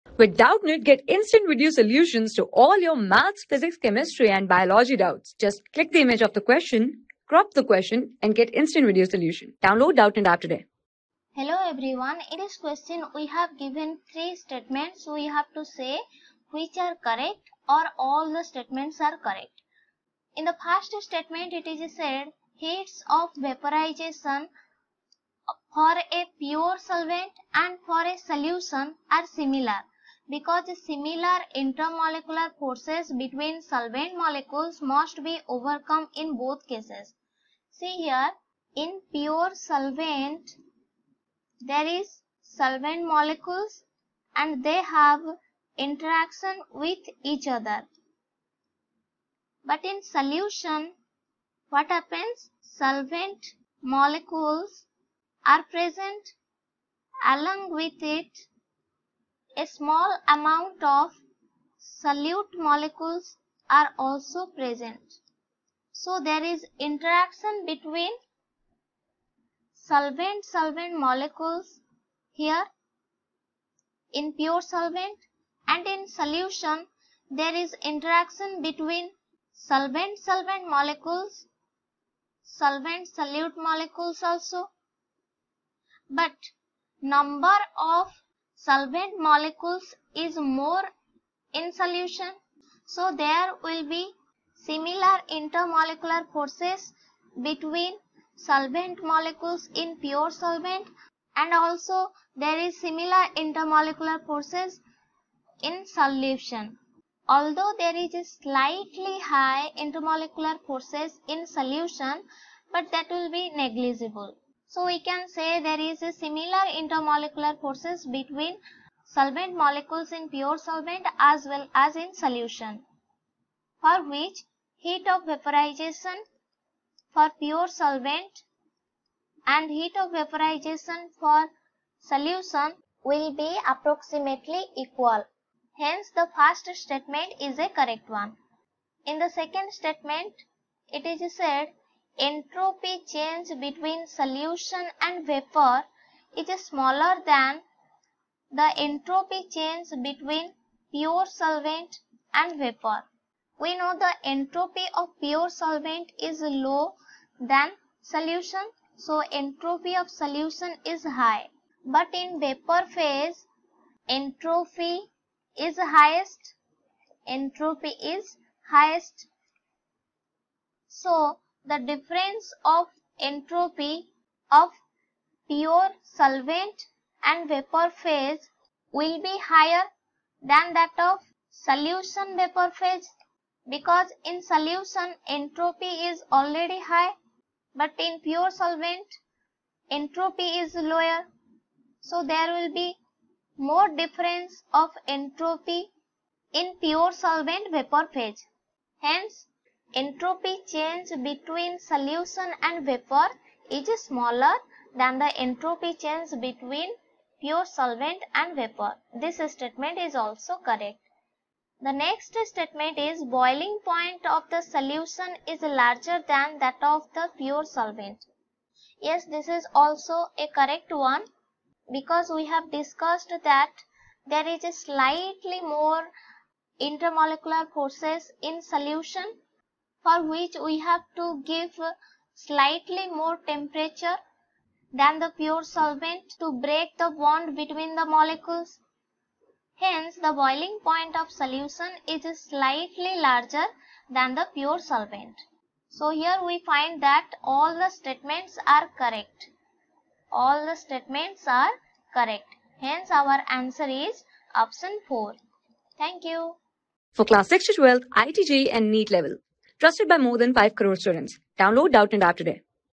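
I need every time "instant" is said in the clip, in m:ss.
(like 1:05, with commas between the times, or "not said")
0:01, 0:08.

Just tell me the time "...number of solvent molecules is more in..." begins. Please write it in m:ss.
1:26.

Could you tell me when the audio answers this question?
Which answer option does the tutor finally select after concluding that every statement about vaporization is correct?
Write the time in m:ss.
4:14.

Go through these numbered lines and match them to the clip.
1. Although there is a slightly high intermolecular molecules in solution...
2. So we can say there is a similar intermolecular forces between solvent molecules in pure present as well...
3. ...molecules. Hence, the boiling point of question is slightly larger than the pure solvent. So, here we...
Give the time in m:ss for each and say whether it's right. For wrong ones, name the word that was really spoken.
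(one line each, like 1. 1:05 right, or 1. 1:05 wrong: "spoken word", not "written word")
1. 1:47 wrong: "forces", not "molecules"
2. 1:54 wrong: "solvent", not "present"
3. 3:58 wrong: "solution", not "question".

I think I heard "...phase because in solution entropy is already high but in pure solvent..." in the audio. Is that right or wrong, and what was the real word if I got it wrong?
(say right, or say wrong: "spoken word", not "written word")
right.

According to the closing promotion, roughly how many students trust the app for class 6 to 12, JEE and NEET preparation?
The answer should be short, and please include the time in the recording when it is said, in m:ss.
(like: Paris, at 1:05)
5 crore, at 4:20.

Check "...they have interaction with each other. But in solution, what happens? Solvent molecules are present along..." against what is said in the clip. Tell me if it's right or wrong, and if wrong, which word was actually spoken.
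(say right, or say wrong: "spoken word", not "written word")
right.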